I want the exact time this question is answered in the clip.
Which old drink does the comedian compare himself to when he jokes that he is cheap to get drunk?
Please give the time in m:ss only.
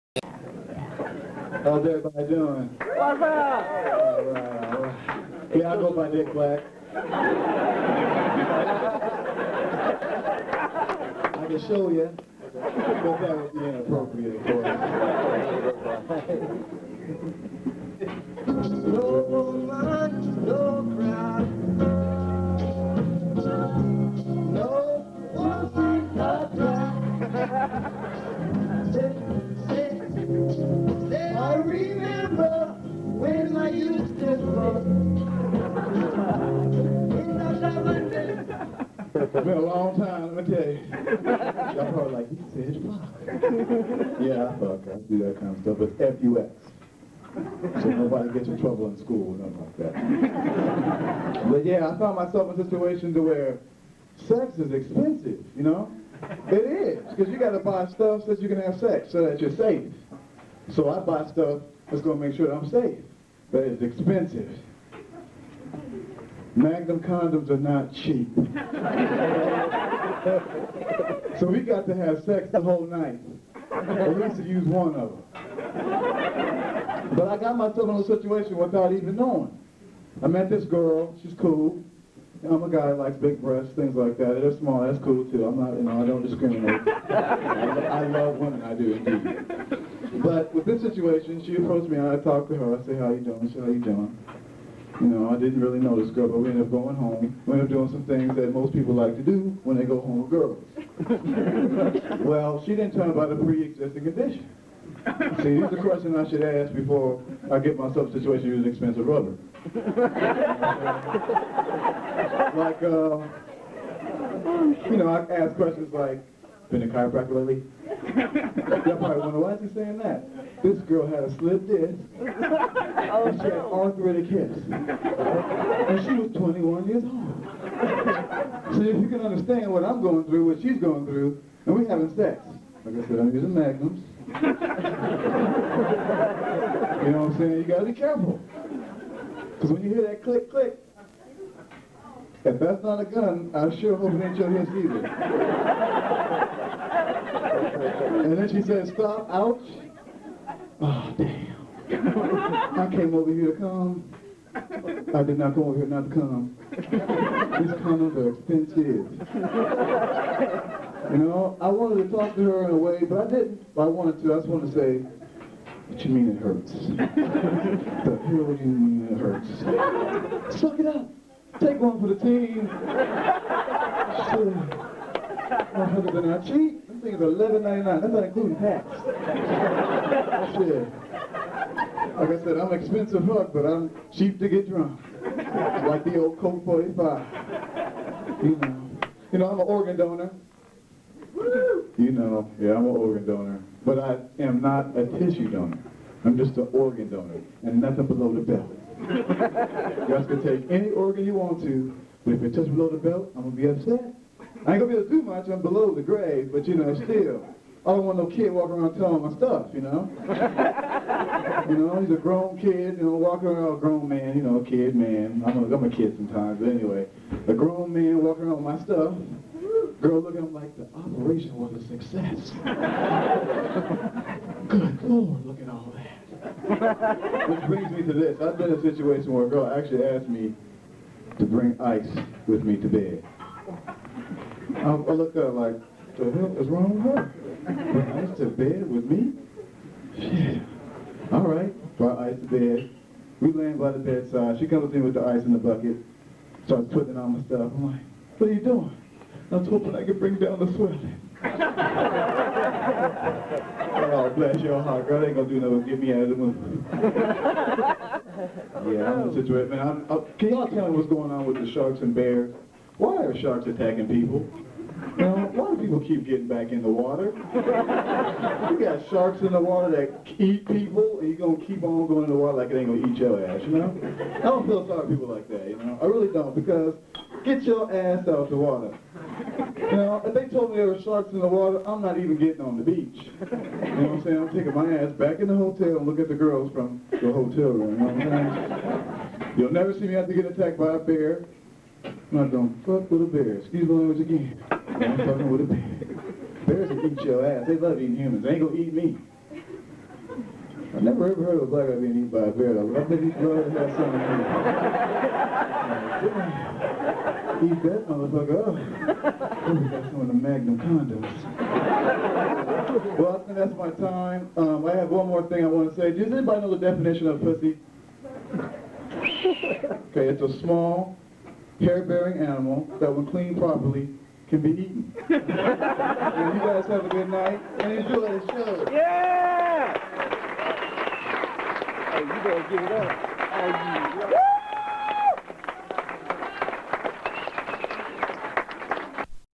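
3:06.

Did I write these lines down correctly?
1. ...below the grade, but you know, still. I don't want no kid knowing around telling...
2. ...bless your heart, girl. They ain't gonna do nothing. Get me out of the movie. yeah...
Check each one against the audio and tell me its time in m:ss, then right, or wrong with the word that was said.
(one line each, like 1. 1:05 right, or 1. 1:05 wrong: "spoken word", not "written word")
1. 3:25 wrong: "walking", not "knowing"
2. 4:14 right.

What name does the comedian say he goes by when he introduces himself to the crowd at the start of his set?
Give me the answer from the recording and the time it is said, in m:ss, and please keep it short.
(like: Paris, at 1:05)
Dick Black, at 0:06.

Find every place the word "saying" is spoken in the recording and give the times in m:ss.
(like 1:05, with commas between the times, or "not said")
1:59, 2:17, 4:44.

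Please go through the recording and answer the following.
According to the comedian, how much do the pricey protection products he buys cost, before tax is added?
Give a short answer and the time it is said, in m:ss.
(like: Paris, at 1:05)
$11.99, at 2:57.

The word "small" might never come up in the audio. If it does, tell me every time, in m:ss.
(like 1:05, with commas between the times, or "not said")
1:24, 5:20.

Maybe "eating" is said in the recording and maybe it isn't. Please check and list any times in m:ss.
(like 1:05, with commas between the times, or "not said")
4:57.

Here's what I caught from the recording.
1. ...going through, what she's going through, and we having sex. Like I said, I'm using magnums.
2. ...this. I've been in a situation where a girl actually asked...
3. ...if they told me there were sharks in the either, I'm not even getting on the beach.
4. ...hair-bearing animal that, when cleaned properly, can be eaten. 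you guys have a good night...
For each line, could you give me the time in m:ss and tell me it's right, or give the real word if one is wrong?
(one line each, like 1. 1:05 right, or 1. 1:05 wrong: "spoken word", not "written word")
1. 2:10 right
2. 3:48 right
3. 4:40 wrong: "water", not "either"
4. 5:21 right.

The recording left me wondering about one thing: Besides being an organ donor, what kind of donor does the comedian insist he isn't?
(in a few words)
tissue donor.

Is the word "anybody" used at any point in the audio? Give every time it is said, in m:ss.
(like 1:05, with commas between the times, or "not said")
5:16.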